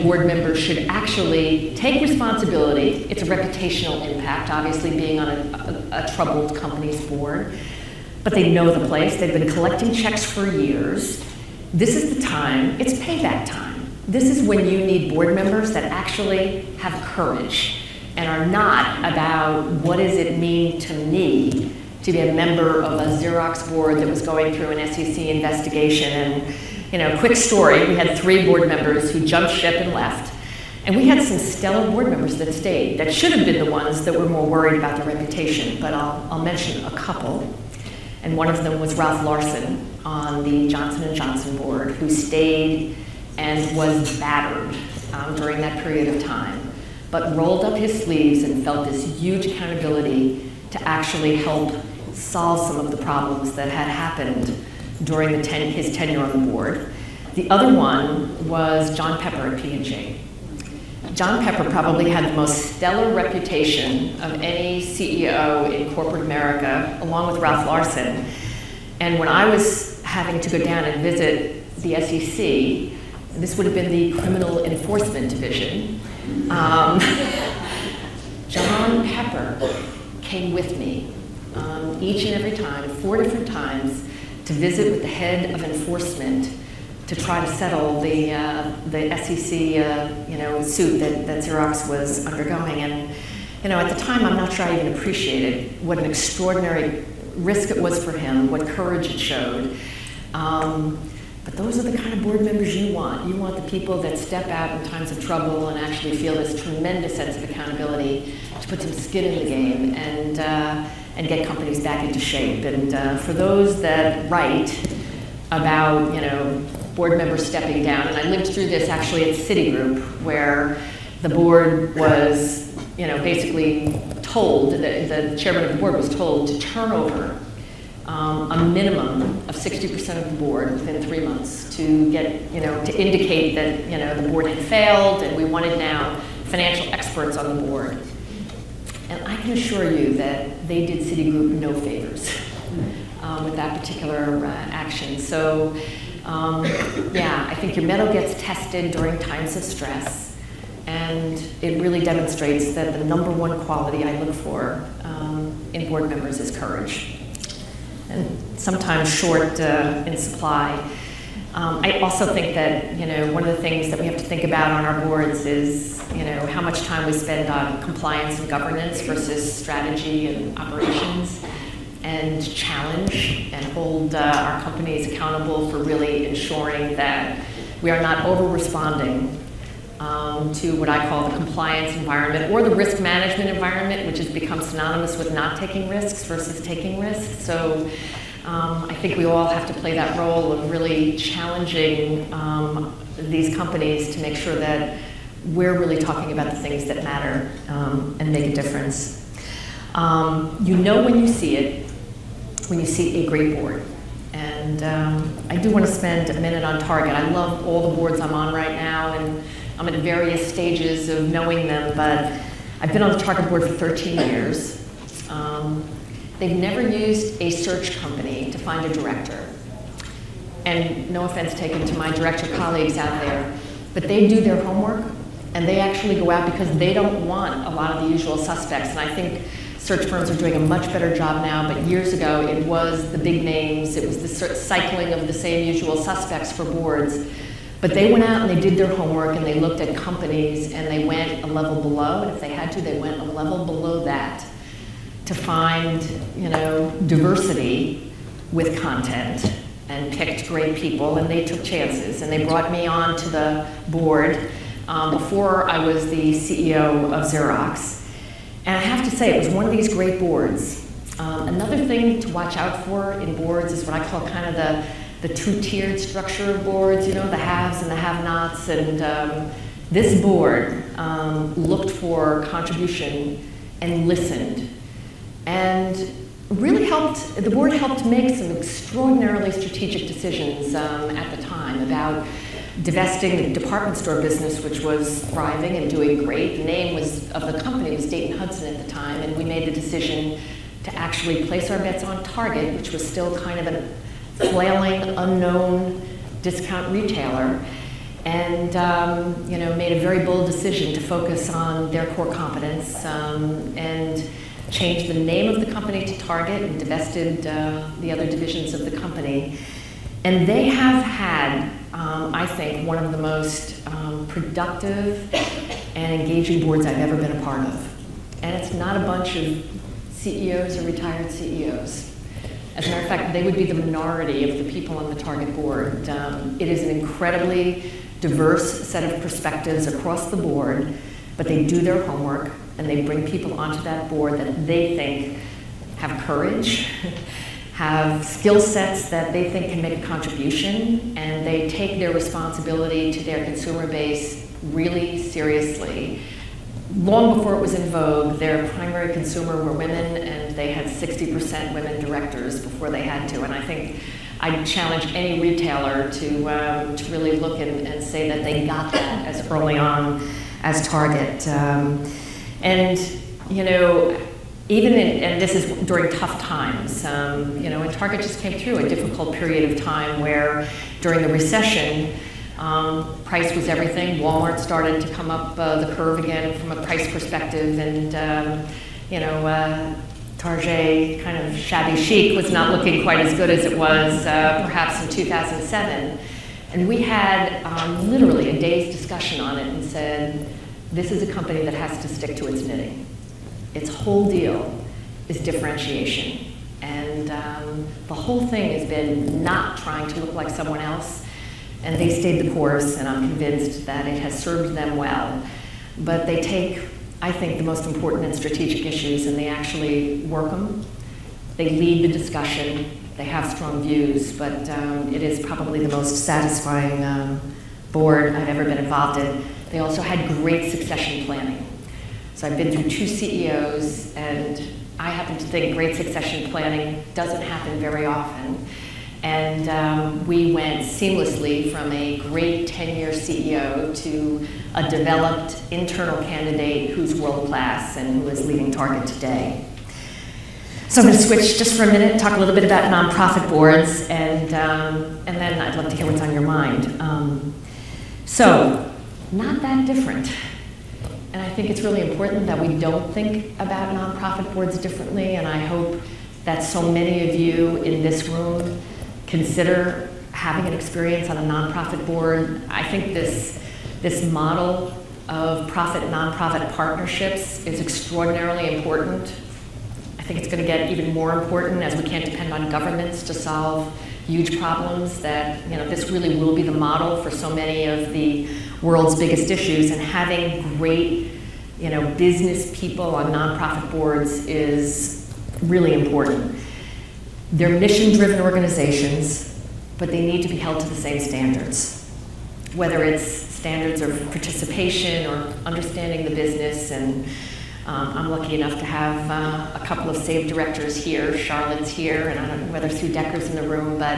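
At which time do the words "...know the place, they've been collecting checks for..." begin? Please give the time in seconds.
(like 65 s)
8 s.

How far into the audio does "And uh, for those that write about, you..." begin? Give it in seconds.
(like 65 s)
112 s.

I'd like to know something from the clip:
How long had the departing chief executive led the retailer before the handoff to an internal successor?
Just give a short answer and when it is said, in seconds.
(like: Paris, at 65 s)
10 years, at 432 s.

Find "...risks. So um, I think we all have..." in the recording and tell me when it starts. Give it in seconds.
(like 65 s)
186 s.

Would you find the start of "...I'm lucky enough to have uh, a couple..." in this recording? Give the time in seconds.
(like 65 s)
498 s.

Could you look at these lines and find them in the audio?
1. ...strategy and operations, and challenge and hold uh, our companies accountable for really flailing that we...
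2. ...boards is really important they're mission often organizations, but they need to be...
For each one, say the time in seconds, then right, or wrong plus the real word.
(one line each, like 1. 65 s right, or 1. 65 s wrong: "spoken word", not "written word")
1. 169 s wrong: "ensuring", not "flailing"
2. 483 s wrong: "driven", not "often".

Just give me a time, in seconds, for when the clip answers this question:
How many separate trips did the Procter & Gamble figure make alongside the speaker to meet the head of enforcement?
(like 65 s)
82 s.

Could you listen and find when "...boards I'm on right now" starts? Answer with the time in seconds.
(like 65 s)
207 s.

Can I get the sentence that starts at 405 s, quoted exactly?
But they take, I think, the most important and strategic issues and they actually work them.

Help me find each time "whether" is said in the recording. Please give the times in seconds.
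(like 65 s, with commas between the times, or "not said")
492 s, 502 s.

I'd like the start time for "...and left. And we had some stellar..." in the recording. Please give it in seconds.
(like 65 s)
29 s.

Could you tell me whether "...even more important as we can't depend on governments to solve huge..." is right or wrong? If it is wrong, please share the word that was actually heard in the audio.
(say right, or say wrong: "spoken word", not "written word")
right.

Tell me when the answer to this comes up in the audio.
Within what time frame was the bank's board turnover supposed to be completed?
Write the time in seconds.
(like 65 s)
131 s.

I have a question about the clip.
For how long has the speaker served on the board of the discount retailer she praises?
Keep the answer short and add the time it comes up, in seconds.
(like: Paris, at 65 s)
13 years, at 213 s.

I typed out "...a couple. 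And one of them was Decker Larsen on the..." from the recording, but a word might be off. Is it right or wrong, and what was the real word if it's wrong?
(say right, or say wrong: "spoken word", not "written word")
wrong: "Ralph", not "Decker".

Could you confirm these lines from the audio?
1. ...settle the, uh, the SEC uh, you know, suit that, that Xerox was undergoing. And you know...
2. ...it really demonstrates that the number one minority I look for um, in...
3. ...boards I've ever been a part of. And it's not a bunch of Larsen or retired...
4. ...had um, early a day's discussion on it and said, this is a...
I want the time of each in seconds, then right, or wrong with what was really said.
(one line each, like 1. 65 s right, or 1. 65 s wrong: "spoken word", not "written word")
1. 87 s right
2. 151 s wrong: "quality", not "minority"
3. 316 s wrong: "CEOs", not "Larsen"
4. 387 s wrong: "literally", not "early".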